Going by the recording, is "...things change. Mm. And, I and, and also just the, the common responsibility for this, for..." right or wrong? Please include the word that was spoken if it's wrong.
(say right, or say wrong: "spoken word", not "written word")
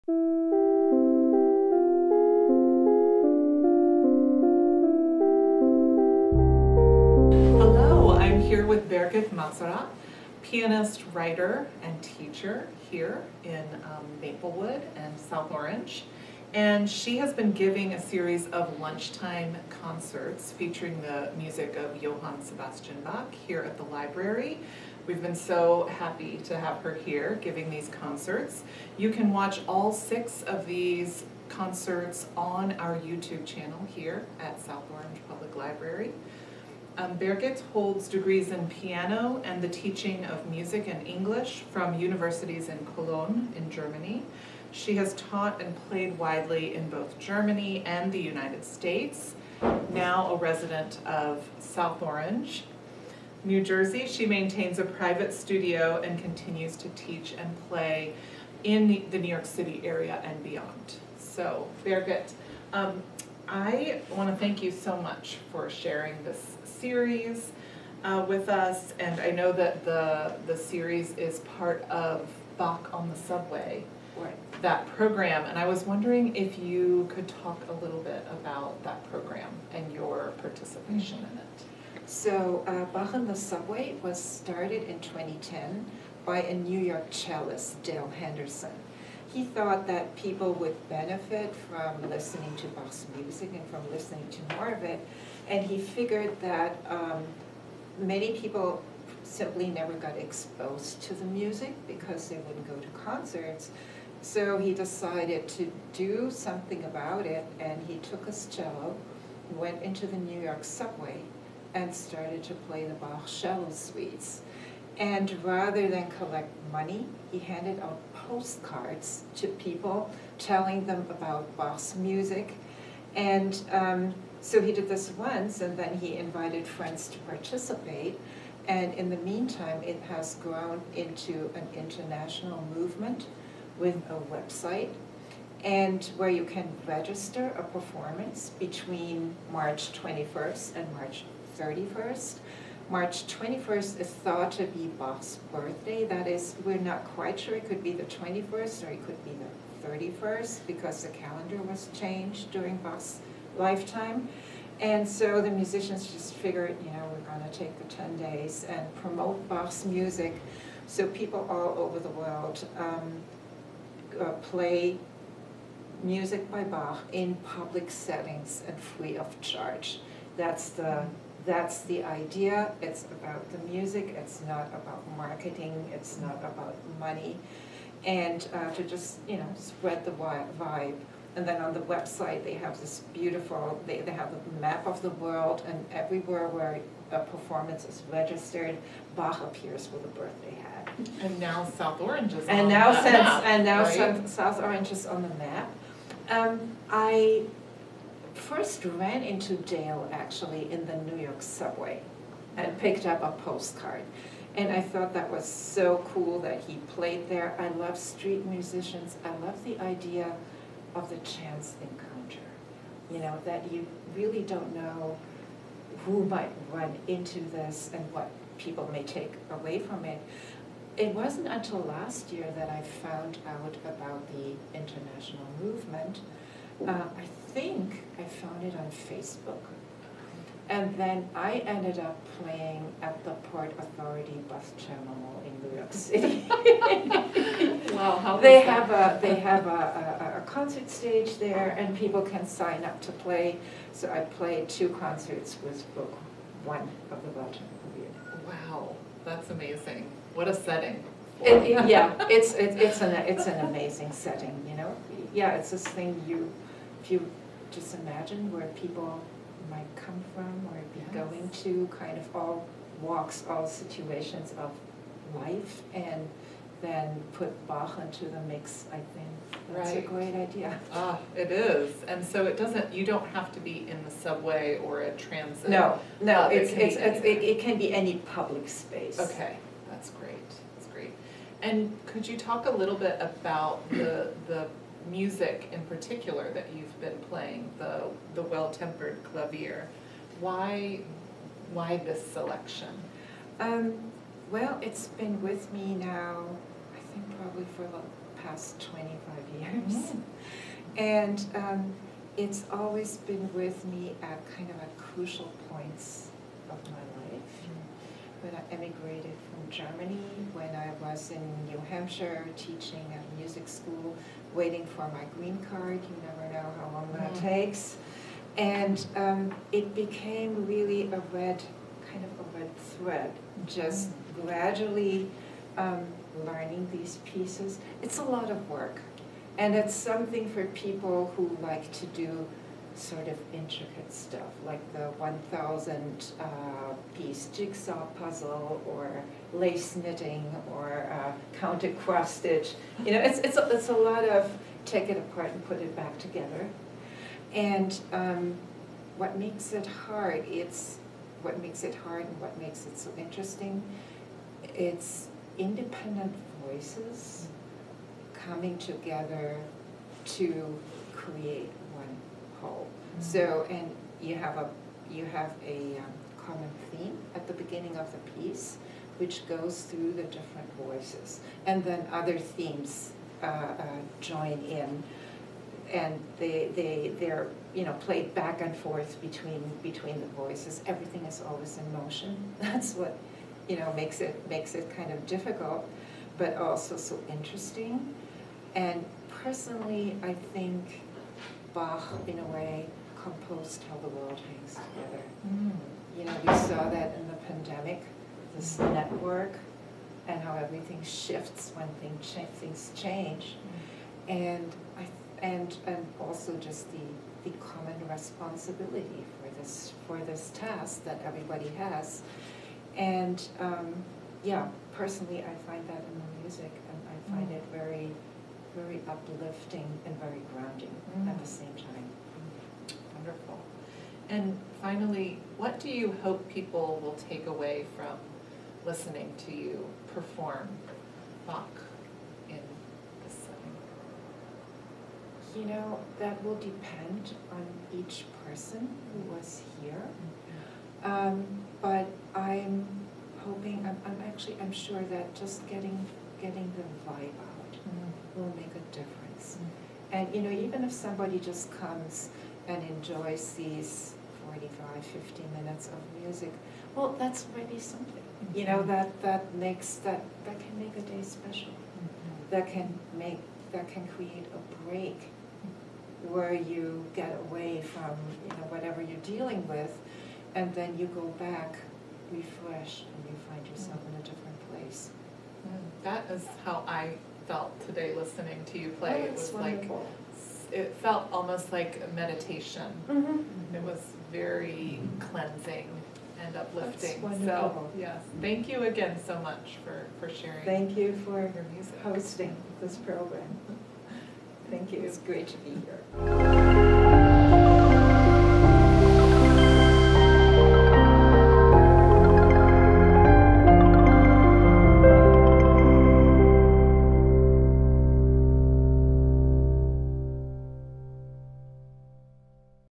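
right.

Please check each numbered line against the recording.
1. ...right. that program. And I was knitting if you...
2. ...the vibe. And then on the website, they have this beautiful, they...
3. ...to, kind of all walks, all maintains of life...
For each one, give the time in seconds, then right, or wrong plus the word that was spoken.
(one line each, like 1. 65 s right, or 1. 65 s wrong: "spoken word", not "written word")
1. 74 s wrong: "wondering", not "knitting"
2. 180 s right
3. 261 s wrong: "situations", not "maintains".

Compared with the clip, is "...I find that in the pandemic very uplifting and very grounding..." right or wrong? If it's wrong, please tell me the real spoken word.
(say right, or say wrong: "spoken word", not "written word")
wrong: "music", not "pandemic".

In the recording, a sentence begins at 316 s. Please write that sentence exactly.
You never know how long that mm-hmm.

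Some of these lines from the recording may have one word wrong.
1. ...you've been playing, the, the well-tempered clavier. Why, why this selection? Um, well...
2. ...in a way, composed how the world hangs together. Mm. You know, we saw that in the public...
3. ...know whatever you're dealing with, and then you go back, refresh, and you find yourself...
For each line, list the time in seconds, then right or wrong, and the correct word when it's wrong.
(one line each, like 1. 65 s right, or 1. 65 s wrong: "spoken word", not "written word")
1. 286 s right
2. 392 s wrong: "pandemic", not "public"
3. 468 s right.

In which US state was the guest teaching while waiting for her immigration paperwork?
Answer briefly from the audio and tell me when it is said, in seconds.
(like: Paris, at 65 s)
New Hampshire, at 311 s.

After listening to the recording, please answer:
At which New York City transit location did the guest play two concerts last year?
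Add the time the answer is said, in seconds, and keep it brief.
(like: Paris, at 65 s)
Port Authority bus terminal, at 233 s.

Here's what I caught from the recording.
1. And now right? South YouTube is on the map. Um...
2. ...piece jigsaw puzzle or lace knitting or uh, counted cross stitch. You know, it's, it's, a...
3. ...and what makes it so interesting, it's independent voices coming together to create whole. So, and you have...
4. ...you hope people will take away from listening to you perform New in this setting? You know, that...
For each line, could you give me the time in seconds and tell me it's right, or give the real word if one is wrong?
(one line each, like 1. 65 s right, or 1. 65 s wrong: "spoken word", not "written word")
1. 193 s wrong: "Orange", not "YouTube"
2. 337 s right
3. 352 s right
4. 425 s wrong: "Bach", not "New".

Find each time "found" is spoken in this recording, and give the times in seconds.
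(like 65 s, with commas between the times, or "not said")
222 s, 228 s.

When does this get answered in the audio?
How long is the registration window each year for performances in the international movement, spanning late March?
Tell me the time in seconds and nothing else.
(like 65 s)
157 s.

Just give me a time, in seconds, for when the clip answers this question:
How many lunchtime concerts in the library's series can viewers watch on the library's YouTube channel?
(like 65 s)
29 s.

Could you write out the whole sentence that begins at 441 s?
Um, but I'm hoping, I'm, I'm actually, I'm sure that just getting, getting the vibe will make a difference.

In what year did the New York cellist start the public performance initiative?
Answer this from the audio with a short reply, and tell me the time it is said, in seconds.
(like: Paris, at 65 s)
2010, at 84 s.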